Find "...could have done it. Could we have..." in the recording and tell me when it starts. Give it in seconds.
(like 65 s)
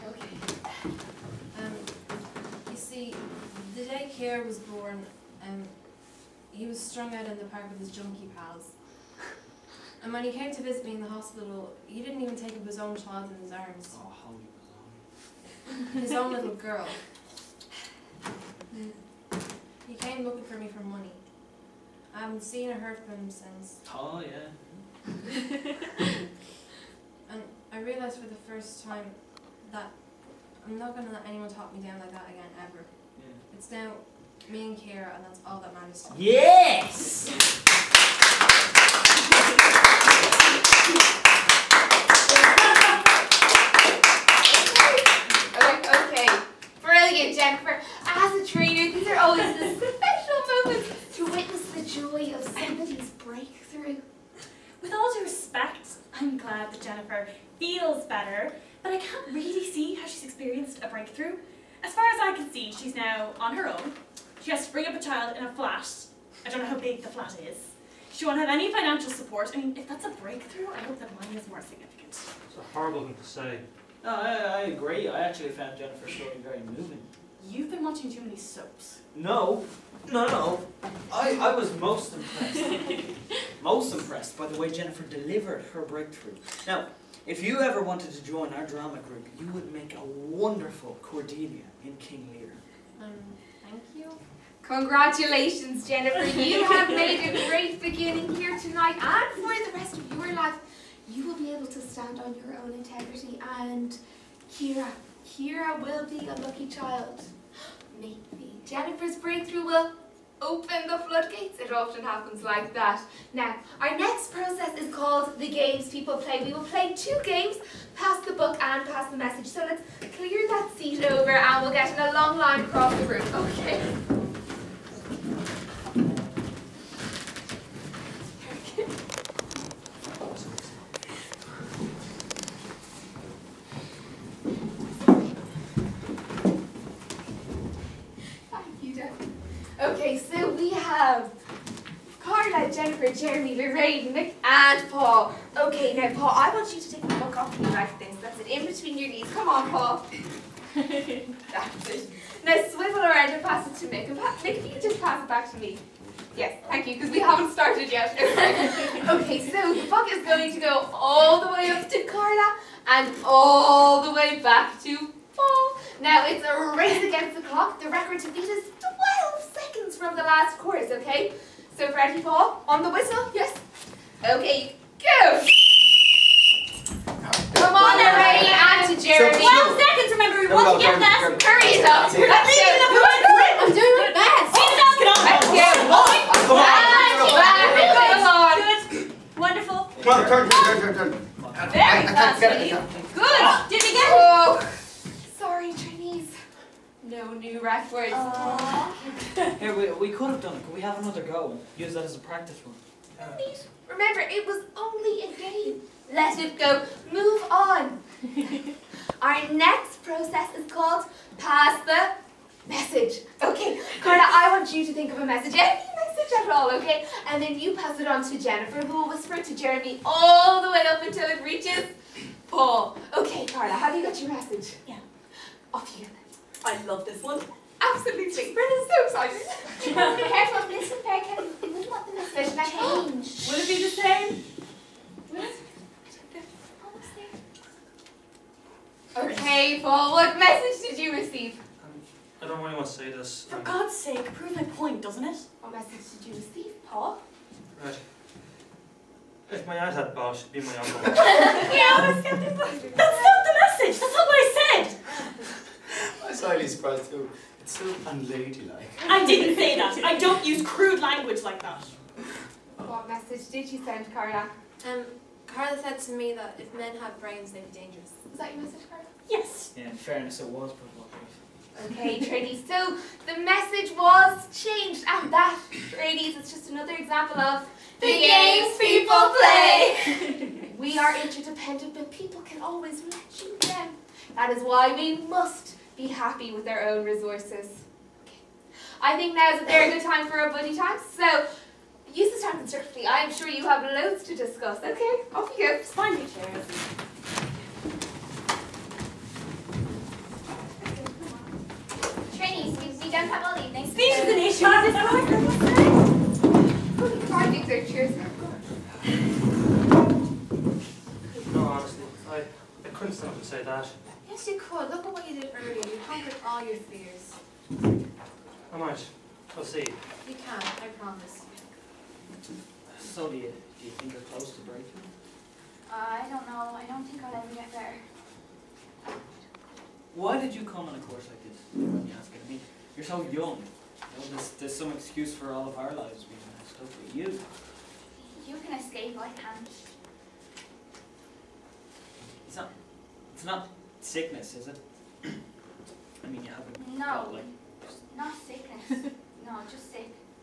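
200 s.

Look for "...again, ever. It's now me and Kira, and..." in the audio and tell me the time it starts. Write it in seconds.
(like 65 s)
32 s.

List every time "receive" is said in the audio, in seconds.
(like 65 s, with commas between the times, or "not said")
241 s, 246 s.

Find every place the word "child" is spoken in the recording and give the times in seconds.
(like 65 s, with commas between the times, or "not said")
12 s, 64 s, 106 s.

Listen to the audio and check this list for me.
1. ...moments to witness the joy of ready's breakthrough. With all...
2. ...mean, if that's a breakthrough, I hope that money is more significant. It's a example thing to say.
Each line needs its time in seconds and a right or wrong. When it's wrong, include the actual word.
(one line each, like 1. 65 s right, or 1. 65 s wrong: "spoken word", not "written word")
1. 50 s wrong: "somebody", not "ready"
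2. 69 s wrong: "horrible", not "example".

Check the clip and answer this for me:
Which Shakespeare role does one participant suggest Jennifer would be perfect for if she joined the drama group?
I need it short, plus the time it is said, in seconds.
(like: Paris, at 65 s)
Cordelia, at 91 s.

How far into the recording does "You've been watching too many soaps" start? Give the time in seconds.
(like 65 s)
77 s.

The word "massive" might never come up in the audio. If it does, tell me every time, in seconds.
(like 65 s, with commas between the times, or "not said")
not said.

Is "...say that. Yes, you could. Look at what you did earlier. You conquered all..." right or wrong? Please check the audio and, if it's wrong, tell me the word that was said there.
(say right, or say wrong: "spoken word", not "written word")
right.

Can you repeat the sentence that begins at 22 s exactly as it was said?
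I haven't seen or heard from him since.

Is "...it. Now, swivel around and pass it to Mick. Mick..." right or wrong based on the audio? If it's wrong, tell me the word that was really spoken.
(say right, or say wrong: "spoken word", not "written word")
right.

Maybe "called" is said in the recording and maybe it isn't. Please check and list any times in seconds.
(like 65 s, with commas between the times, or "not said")
114 s, 210 s.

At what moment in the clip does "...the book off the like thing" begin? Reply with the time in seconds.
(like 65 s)
147 s.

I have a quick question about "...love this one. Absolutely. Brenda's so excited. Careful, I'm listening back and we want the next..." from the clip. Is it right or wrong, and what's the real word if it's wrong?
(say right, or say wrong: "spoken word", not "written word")
right.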